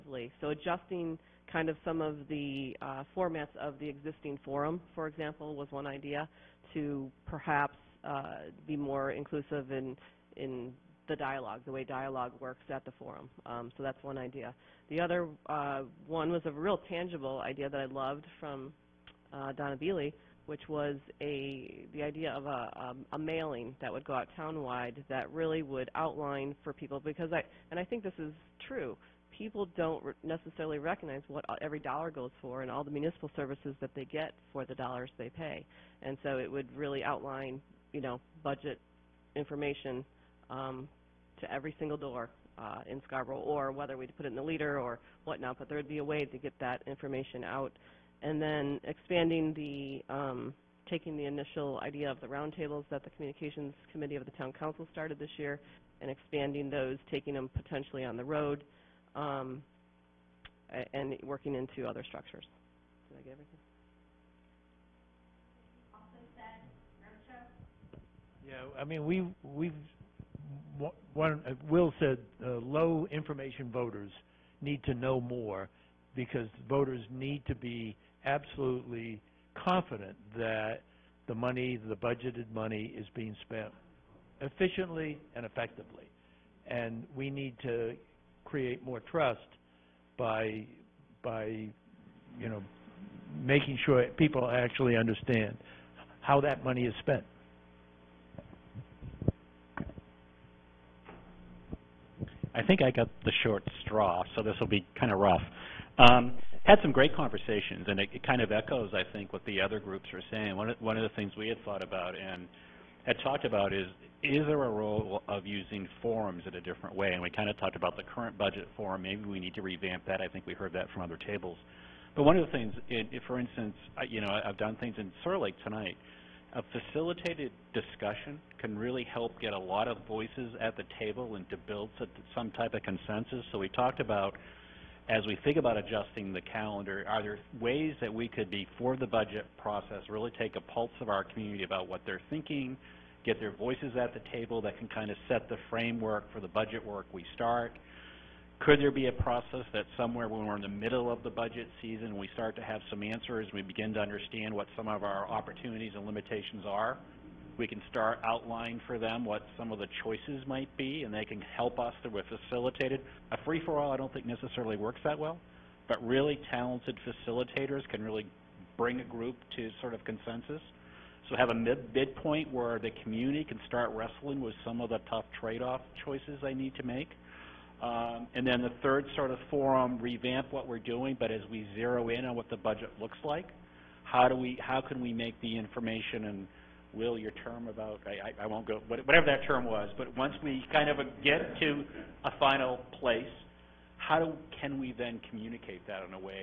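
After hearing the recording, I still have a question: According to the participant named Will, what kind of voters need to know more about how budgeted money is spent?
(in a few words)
low information voters.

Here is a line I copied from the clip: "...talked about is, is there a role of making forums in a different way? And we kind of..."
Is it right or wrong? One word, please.
wrong.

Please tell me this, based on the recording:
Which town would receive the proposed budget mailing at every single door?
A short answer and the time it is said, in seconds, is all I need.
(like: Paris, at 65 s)
Scarborough, at 43 s.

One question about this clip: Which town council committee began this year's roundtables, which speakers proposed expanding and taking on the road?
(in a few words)
Communications Committee.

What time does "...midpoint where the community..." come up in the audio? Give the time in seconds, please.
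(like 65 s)
171 s.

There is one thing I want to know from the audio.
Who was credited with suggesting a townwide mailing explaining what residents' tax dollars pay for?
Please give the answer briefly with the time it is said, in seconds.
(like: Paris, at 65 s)
Donna Beeley, at 19 s.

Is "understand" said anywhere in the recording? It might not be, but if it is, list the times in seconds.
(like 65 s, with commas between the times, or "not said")
94 s, 153 s.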